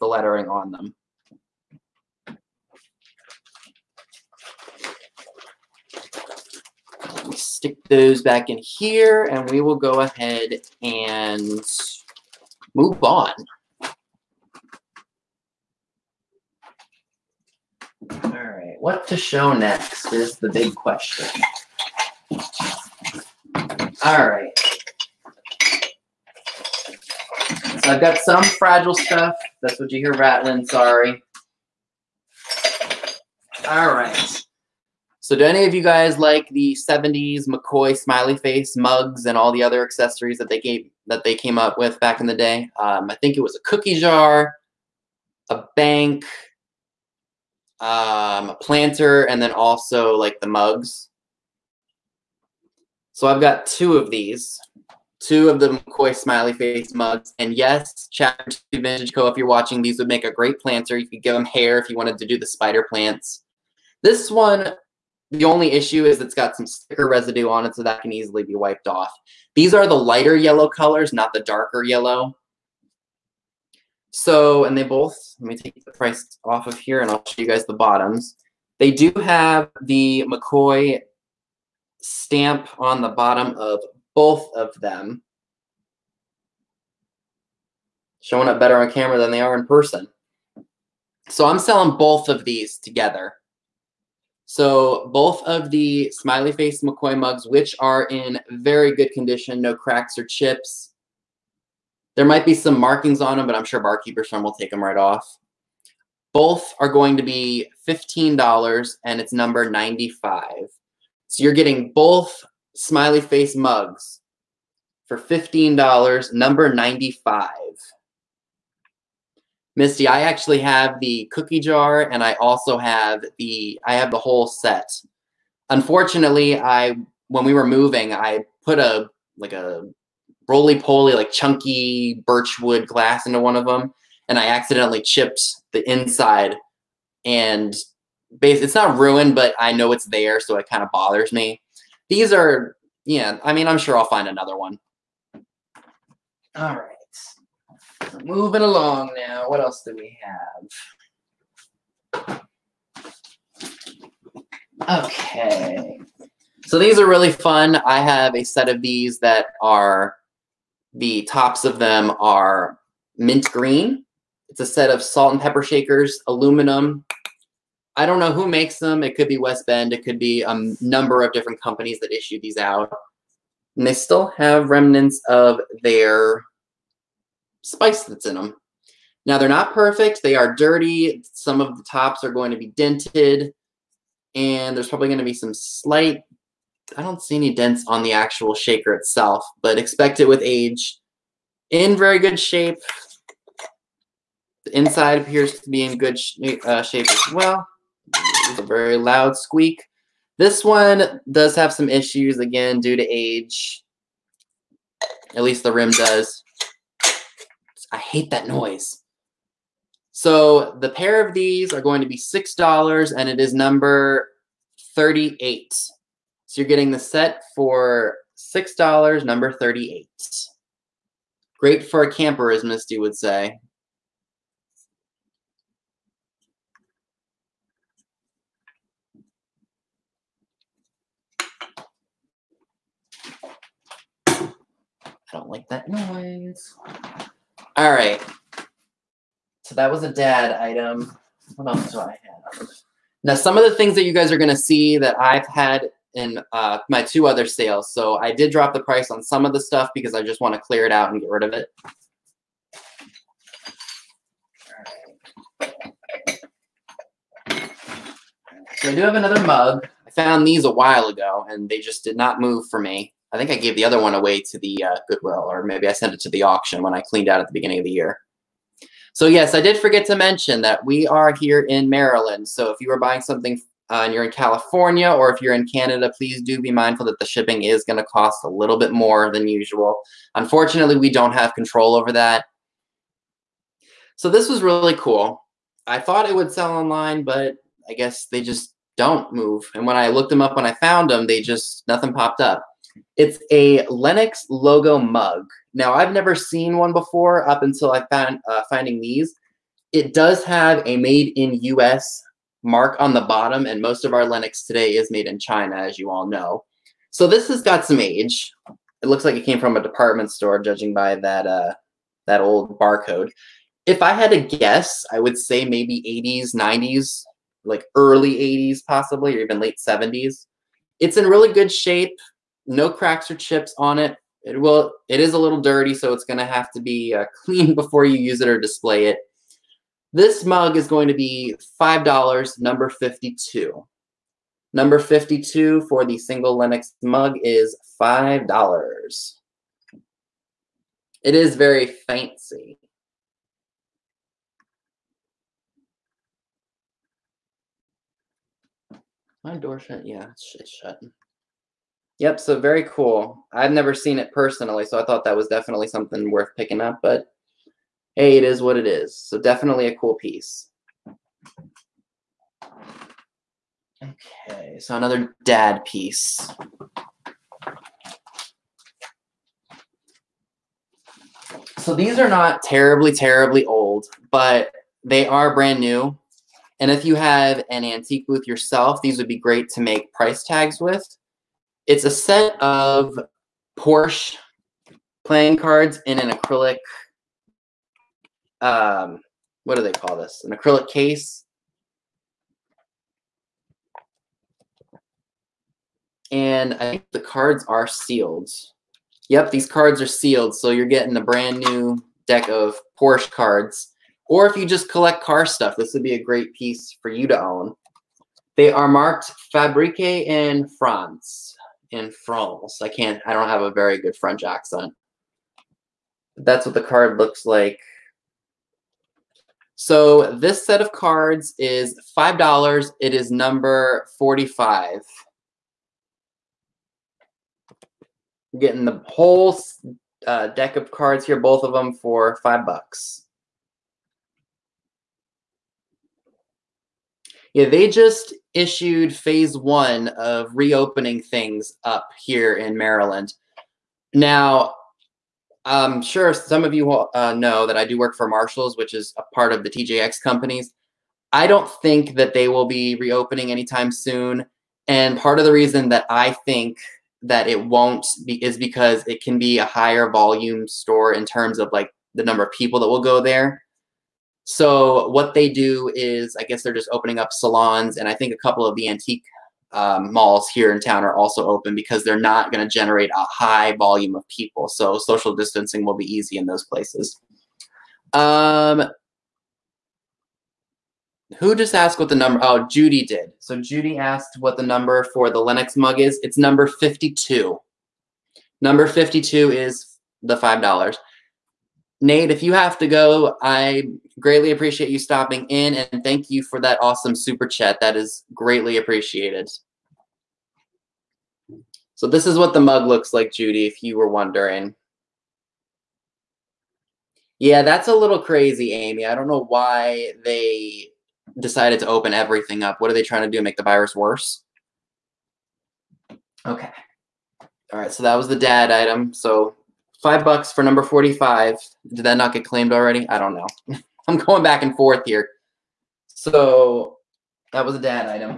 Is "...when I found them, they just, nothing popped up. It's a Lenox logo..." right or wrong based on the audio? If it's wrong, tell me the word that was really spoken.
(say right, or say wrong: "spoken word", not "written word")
right.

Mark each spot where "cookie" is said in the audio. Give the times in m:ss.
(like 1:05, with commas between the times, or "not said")
0:43, 2:01.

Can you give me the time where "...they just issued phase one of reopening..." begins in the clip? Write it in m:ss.
7:17.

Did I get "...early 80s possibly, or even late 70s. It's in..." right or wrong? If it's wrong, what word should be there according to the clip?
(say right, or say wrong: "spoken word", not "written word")
right.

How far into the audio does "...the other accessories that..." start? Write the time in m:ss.
0:39.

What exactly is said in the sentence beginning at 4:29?
So yes, I did forget to mention that we are here in Maryland.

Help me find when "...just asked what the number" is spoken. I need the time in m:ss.
8:01.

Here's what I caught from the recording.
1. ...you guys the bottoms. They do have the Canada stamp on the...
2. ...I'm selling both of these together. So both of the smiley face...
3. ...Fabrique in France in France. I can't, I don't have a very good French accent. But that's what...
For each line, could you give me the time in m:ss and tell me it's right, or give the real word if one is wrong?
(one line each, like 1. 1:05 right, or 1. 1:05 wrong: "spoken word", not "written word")
1. 1:17 wrong: "McCoy", not "Canada"
2. 1:31 right
3. 6:49 right.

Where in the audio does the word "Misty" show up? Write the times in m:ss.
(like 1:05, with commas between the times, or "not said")
1:59, 3:42.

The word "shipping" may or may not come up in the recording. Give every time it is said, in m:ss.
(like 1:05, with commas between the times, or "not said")
4:37.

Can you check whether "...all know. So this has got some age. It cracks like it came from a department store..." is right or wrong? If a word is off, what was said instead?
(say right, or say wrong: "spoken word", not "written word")
wrong: "looks", not "cracks".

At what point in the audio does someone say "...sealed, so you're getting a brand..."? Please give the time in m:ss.
6:40.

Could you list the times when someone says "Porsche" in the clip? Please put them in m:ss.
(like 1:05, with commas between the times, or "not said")
6:23, 6:42.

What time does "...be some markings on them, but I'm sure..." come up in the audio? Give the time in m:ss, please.
1:42.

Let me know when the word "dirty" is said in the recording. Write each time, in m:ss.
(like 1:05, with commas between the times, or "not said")
3:00, 5:25.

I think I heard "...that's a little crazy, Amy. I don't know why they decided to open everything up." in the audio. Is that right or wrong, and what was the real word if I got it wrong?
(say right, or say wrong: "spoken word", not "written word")
right.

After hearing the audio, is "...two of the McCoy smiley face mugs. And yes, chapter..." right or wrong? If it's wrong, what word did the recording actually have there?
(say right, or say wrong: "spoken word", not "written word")
right.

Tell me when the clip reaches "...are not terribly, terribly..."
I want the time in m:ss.
6:12.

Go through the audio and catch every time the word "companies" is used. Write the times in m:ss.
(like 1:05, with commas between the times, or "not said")
2:51, 7:30.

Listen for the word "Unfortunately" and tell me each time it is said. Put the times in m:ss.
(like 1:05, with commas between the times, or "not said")
2:05, 4:40.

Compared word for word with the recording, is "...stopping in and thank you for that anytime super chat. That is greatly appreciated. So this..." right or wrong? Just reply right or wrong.
wrong.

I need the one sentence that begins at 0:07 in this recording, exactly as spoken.
stick those back in here and we will go ahead and move on.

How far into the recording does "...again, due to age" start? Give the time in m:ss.
3:22.